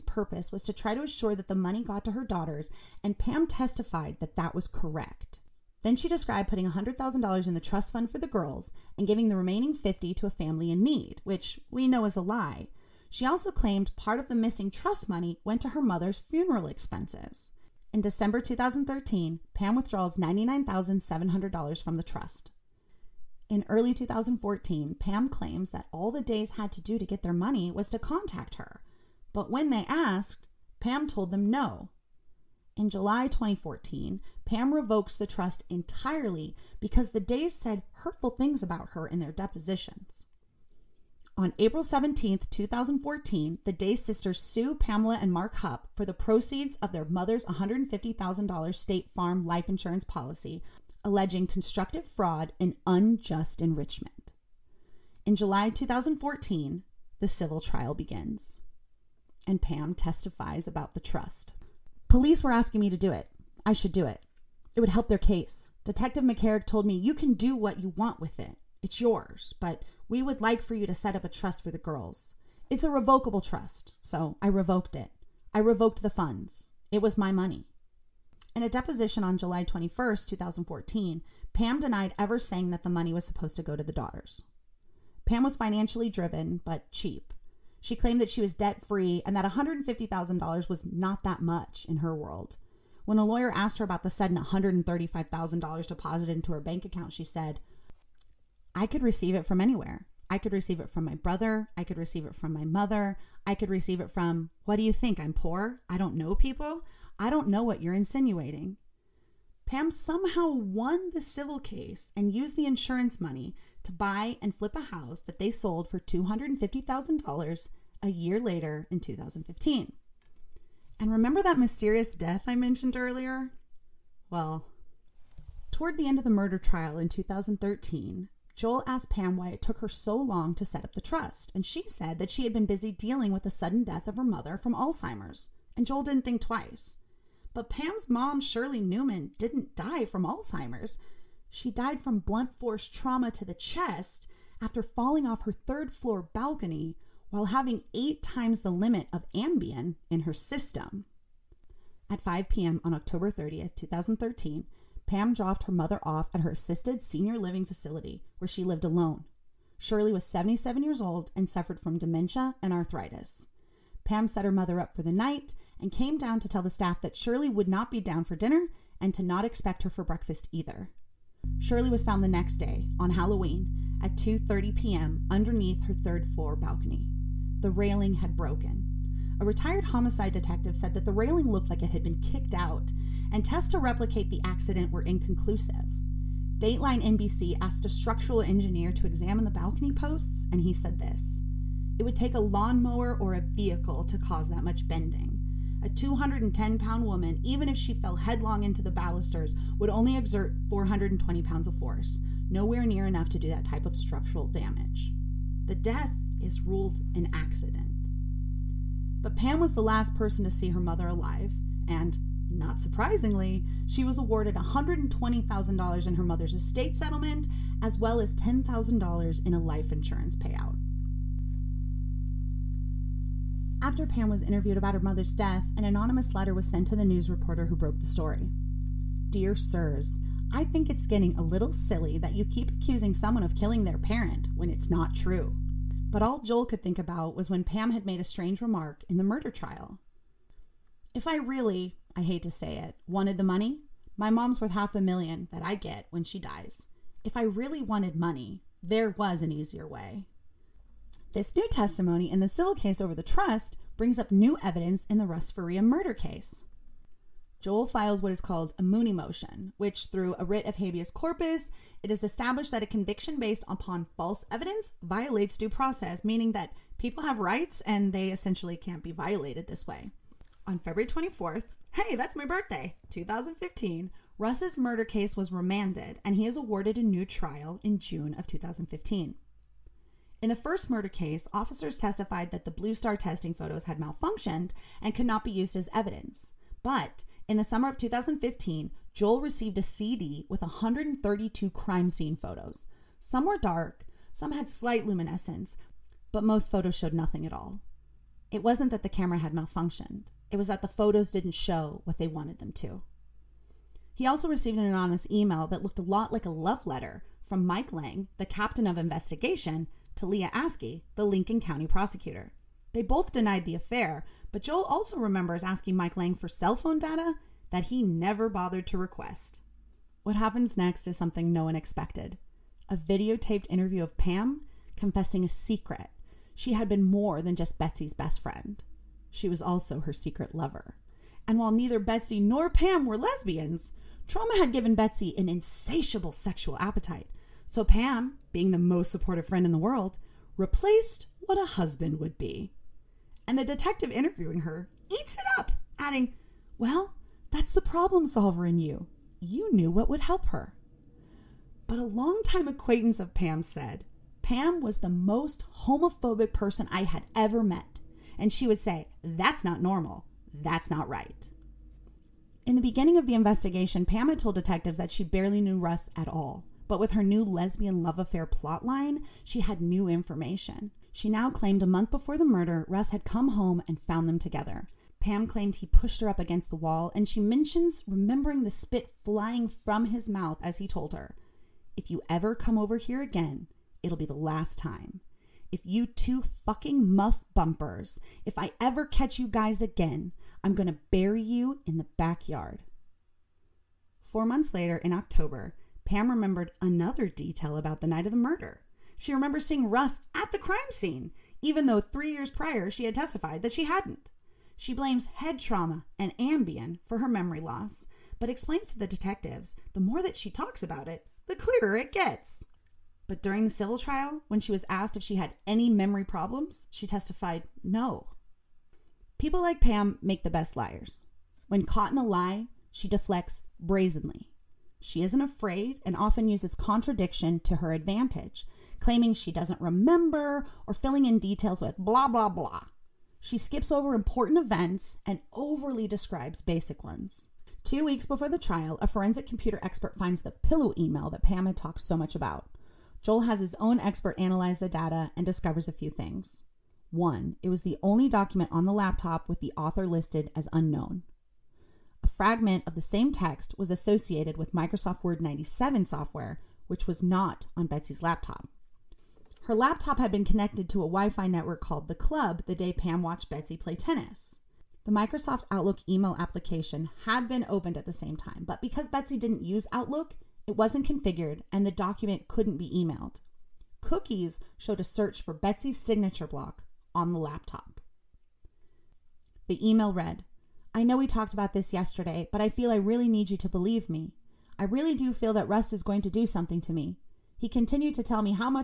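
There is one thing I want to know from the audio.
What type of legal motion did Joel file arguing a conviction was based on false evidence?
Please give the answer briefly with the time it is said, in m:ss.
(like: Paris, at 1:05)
Mooney motion, at 4:18.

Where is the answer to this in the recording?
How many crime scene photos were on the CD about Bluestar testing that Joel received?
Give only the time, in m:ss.
4:50.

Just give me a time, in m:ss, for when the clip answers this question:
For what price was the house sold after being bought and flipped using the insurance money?
1:55.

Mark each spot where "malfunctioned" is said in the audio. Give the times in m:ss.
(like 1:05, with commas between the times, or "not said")
4:43, 4:59.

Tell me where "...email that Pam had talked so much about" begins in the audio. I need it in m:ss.
7:20.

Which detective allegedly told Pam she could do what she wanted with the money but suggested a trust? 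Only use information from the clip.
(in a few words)
McCarrick.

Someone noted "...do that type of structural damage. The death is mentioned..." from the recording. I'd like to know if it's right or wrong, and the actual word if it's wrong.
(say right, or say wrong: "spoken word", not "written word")
wrong: "ruled", not "mentioned".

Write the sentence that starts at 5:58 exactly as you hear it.
And she would say, That's not normal.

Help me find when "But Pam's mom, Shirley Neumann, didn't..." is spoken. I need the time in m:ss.
2:17.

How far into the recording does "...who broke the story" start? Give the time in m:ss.
3:47.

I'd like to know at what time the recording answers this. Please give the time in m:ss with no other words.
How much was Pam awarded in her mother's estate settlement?
3:34.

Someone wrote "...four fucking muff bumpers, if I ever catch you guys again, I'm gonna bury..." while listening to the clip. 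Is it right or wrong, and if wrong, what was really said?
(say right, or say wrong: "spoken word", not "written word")
wrong: "two", not "four".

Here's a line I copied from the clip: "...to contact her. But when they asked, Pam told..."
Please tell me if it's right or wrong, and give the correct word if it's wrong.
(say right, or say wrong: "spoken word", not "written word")
right.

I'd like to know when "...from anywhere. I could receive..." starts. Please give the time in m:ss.
1:39.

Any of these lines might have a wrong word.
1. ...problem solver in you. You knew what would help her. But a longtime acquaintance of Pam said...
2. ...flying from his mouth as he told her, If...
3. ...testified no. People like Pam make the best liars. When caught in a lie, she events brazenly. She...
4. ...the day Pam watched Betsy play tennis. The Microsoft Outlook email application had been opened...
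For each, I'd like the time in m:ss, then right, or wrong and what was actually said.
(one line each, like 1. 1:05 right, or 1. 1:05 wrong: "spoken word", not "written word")
1. 5:47 right
2. 6:19 right
3. 6:57 wrong: "deflects", not "events"
4. 7:42 right.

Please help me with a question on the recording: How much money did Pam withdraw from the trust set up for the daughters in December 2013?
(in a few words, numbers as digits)
$99,700.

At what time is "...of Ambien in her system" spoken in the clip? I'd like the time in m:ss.
2:29.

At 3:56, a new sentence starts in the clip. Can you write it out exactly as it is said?
But all Joel could think about was when Pam had made a strange remark in the murder trial.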